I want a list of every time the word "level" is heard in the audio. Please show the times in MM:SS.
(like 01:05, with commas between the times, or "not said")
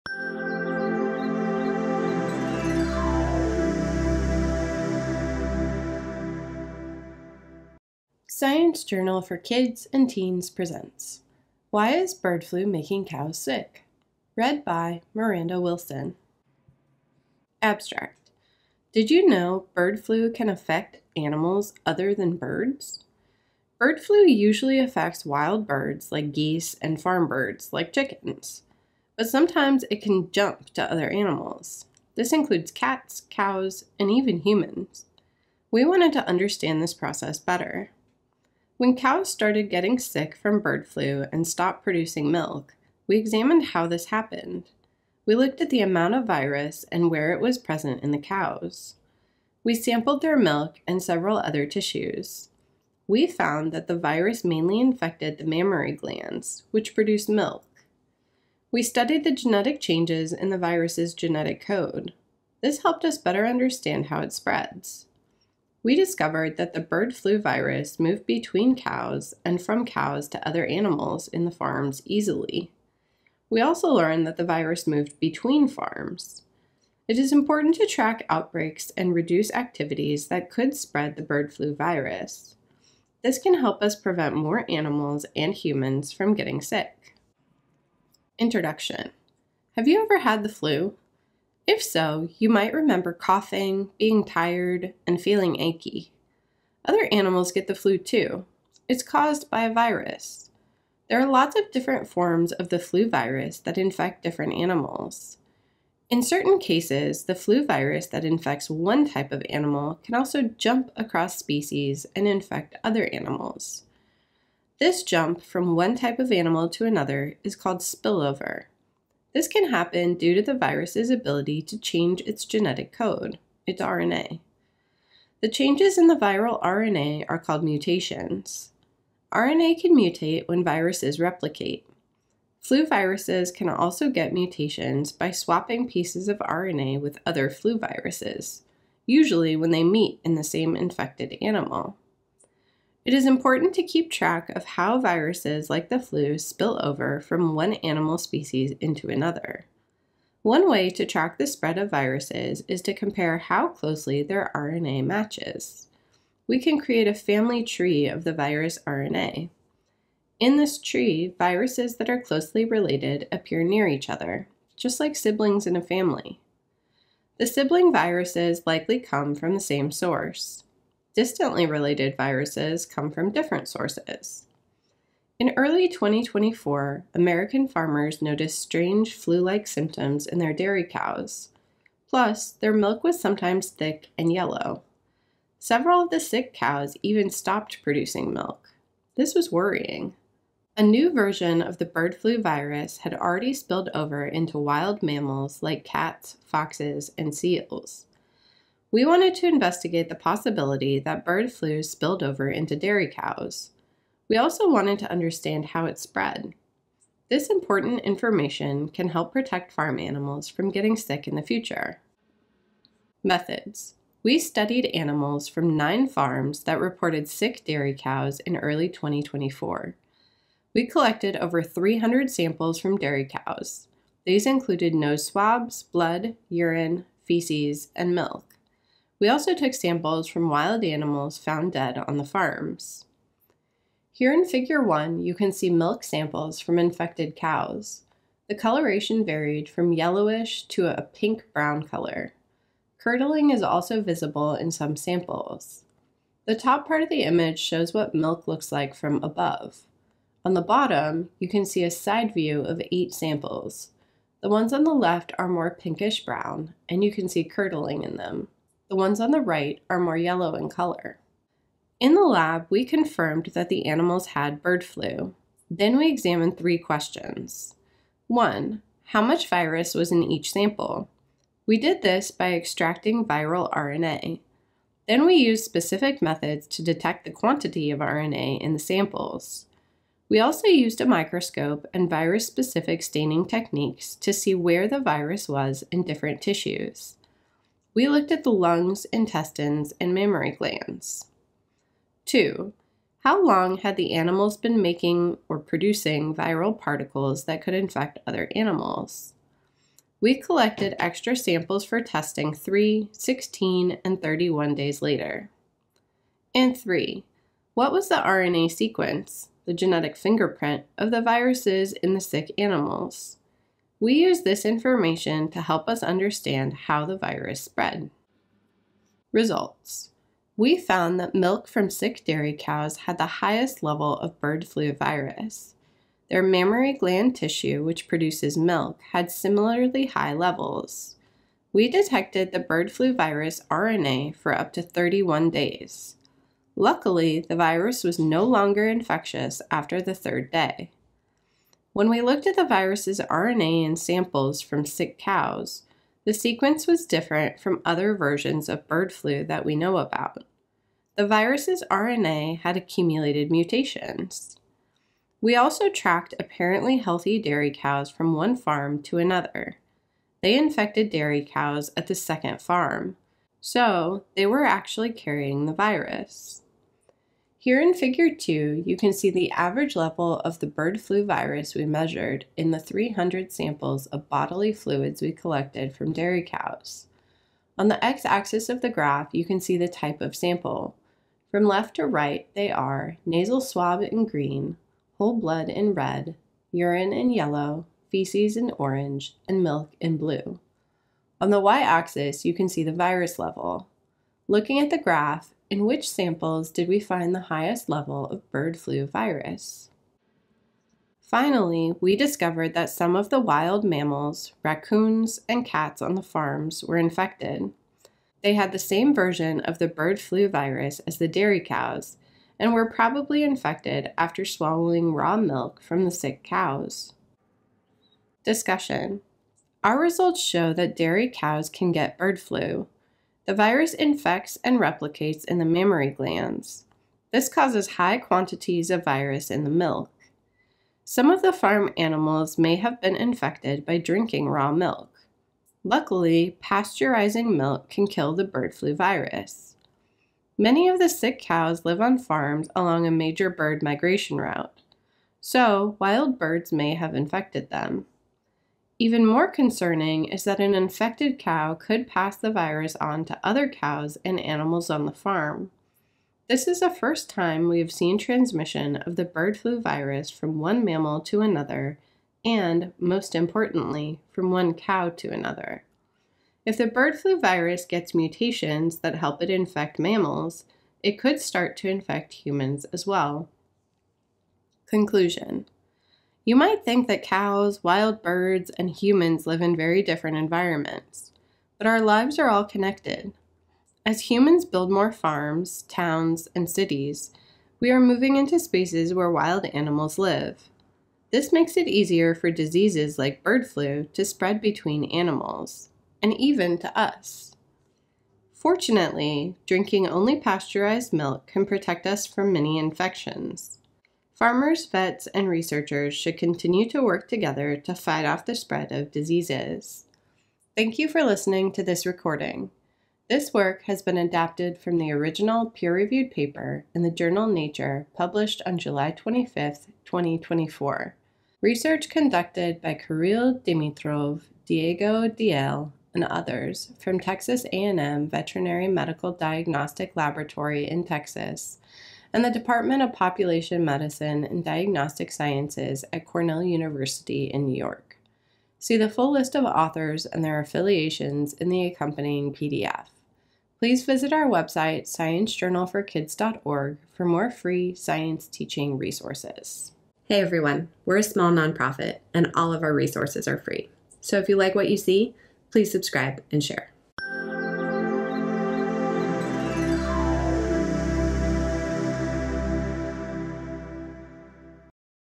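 05:23, 05:30, 06:09, 06:33, 06:37.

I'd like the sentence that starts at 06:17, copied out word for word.
On the x-axis of the graph, you can see the type of sample.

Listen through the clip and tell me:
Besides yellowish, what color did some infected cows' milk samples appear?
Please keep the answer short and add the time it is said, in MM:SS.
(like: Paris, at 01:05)
Pink-brown, at 04:01.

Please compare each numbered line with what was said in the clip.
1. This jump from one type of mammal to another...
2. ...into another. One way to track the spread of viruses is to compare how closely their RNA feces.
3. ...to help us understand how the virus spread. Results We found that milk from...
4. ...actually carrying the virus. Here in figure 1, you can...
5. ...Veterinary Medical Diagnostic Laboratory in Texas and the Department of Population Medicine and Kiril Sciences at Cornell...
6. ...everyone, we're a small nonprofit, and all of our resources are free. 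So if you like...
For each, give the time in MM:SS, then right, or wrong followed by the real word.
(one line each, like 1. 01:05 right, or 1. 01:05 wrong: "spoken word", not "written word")
1. 01:54 wrong: "animal", not "mammal"
2. 02:28 wrong: "matches", not "feces"
3. 05:15 right
4. 06:04 wrong: "2", not "1"
5. 08:48 wrong: "Diagnostic", not "Kiril"
6. 09:10 right.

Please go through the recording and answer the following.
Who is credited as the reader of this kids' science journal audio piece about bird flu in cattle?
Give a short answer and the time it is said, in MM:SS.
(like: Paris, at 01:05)
Miranda Wilson, at 00:15.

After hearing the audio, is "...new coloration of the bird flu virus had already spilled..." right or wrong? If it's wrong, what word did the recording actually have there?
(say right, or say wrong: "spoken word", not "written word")
wrong: "version", not "coloration".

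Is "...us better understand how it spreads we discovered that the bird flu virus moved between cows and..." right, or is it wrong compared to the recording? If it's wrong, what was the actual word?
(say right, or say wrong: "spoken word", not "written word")
right.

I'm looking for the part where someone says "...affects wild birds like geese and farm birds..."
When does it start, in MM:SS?
00:24.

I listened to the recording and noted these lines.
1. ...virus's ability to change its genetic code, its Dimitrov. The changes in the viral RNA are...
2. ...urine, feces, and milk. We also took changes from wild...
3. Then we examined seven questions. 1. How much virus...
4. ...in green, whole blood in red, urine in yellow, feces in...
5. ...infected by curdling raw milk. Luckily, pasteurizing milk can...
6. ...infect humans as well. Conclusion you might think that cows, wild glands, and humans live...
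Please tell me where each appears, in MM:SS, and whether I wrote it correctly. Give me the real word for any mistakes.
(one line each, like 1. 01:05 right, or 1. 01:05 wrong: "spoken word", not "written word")
1. 02:00 wrong: "RNA", not "Dimitrov"
2. 03:46 wrong: "samples", not "changes"
3. 04:25 wrong: "three", not "seven"
4. 06:24 right
5. 07:13 wrong: "drinking", not "curdling"
6. 07:51 wrong: "birds", not "glands".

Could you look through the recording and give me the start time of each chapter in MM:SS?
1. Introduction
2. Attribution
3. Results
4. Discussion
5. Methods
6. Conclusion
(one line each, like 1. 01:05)
1. 01:28
2. 08:30
3. 05:19
4. 06:58
5. 03:33
6. 07:54.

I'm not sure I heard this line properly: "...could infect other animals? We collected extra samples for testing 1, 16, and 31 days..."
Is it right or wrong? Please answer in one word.
wrong.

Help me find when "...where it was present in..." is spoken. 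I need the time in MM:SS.
00:47.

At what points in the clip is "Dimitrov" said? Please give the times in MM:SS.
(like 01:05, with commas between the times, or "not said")
08:43.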